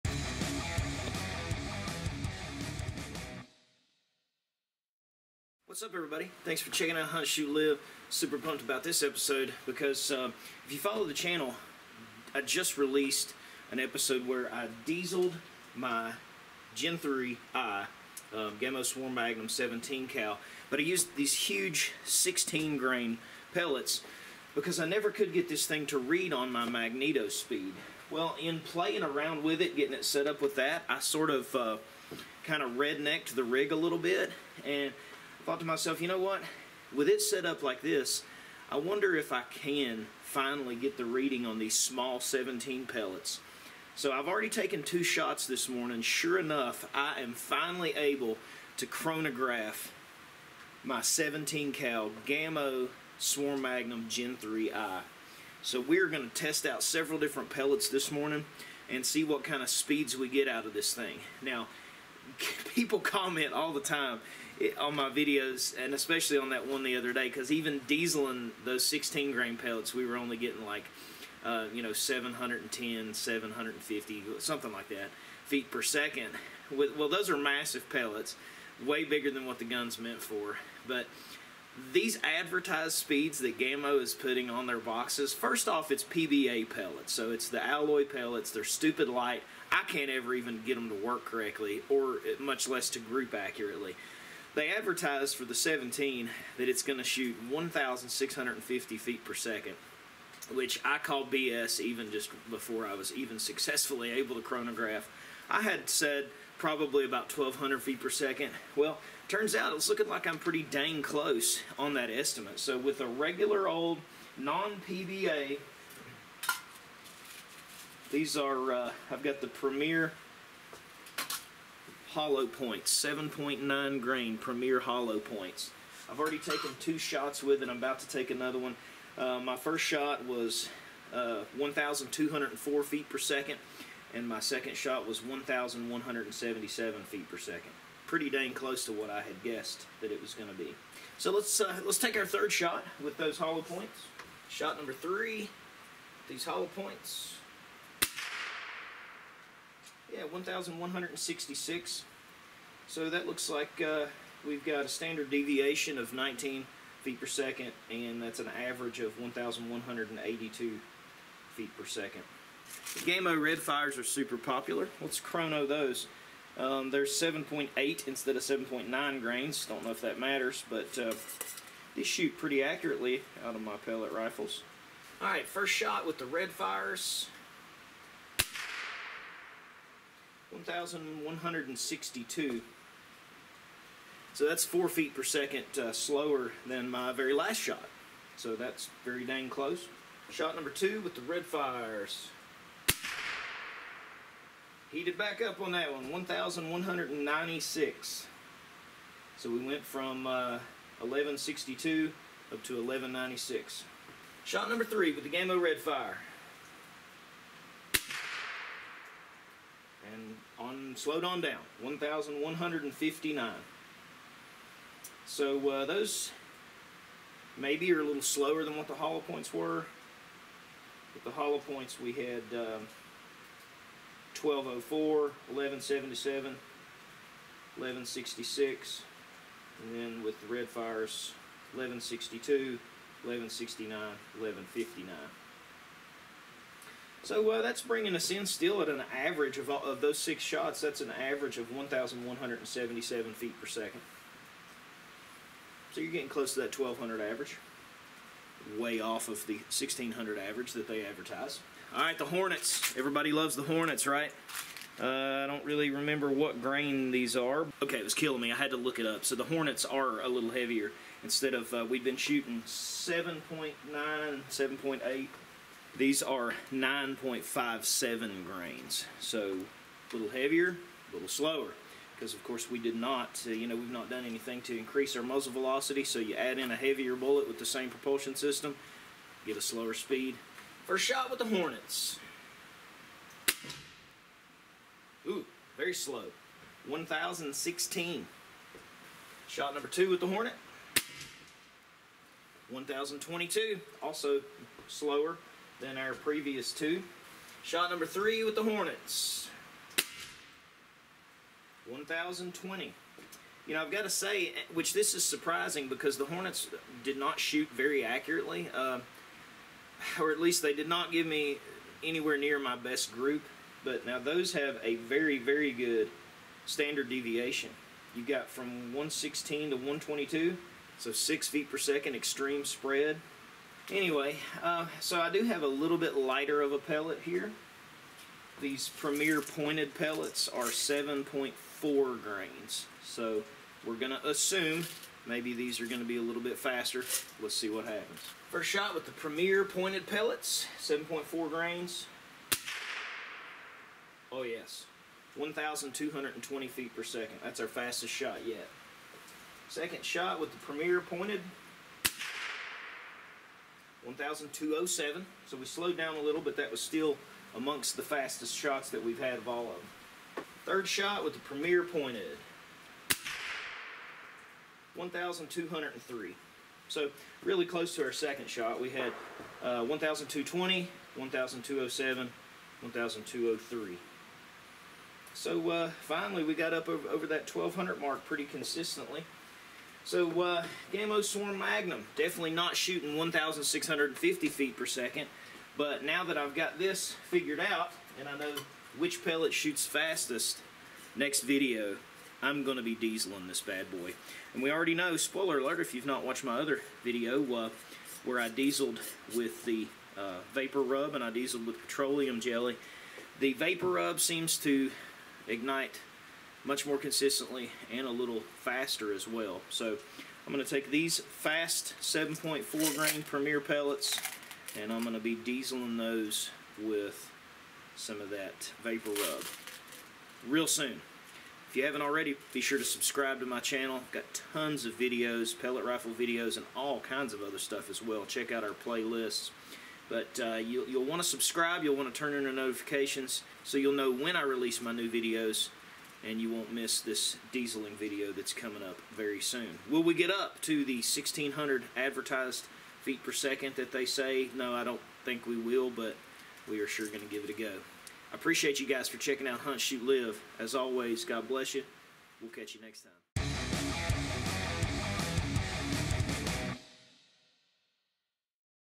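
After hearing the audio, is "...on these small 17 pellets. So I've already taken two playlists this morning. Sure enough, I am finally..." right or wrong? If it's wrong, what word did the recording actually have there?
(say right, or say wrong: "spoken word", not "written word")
wrong: "shots", not "playlists".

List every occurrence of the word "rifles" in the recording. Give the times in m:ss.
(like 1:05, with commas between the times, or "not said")
2:54, 7:05.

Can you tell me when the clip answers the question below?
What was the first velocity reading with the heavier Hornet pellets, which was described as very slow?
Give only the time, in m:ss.
4:46.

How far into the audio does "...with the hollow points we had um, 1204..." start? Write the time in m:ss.
3:41.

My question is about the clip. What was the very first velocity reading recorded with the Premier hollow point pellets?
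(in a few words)
1,204 feet per second.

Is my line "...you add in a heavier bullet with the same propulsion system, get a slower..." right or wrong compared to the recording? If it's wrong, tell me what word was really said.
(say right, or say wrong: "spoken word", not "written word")
right.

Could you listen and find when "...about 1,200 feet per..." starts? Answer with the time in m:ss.
1:47.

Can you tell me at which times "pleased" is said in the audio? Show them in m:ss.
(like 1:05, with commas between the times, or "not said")
not said.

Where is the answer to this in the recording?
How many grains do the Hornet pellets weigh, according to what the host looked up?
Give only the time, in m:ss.
4:26.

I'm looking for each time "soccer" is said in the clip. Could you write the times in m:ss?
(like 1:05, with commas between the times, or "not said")
not said.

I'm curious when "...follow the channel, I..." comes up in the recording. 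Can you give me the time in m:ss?
0:10.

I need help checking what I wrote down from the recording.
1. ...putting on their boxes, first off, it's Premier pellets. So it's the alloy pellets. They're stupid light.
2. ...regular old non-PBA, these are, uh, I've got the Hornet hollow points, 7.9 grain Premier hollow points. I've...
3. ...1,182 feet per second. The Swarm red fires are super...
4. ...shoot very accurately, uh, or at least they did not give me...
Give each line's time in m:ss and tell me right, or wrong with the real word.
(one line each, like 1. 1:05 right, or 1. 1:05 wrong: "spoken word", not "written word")
1. 1:24 wrong: "PBA", not "Premier"
2. 1:53 wrong: "Premier", not "Hornet"
3. 2:39 wrong: "Gamo", not "Swarm"
4. 5:07 right.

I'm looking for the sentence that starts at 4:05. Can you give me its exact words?
So you're getting close to that 1,200 average.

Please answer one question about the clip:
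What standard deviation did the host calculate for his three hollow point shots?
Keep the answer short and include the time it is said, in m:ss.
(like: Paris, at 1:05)
19 feet per second, at 2:36.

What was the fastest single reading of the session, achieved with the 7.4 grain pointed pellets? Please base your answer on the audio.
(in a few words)
1,220 feet per second.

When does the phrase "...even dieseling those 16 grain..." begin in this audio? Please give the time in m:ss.
1:07.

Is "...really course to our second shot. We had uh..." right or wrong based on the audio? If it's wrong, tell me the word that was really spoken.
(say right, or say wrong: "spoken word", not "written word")
wrong: "close", not "course".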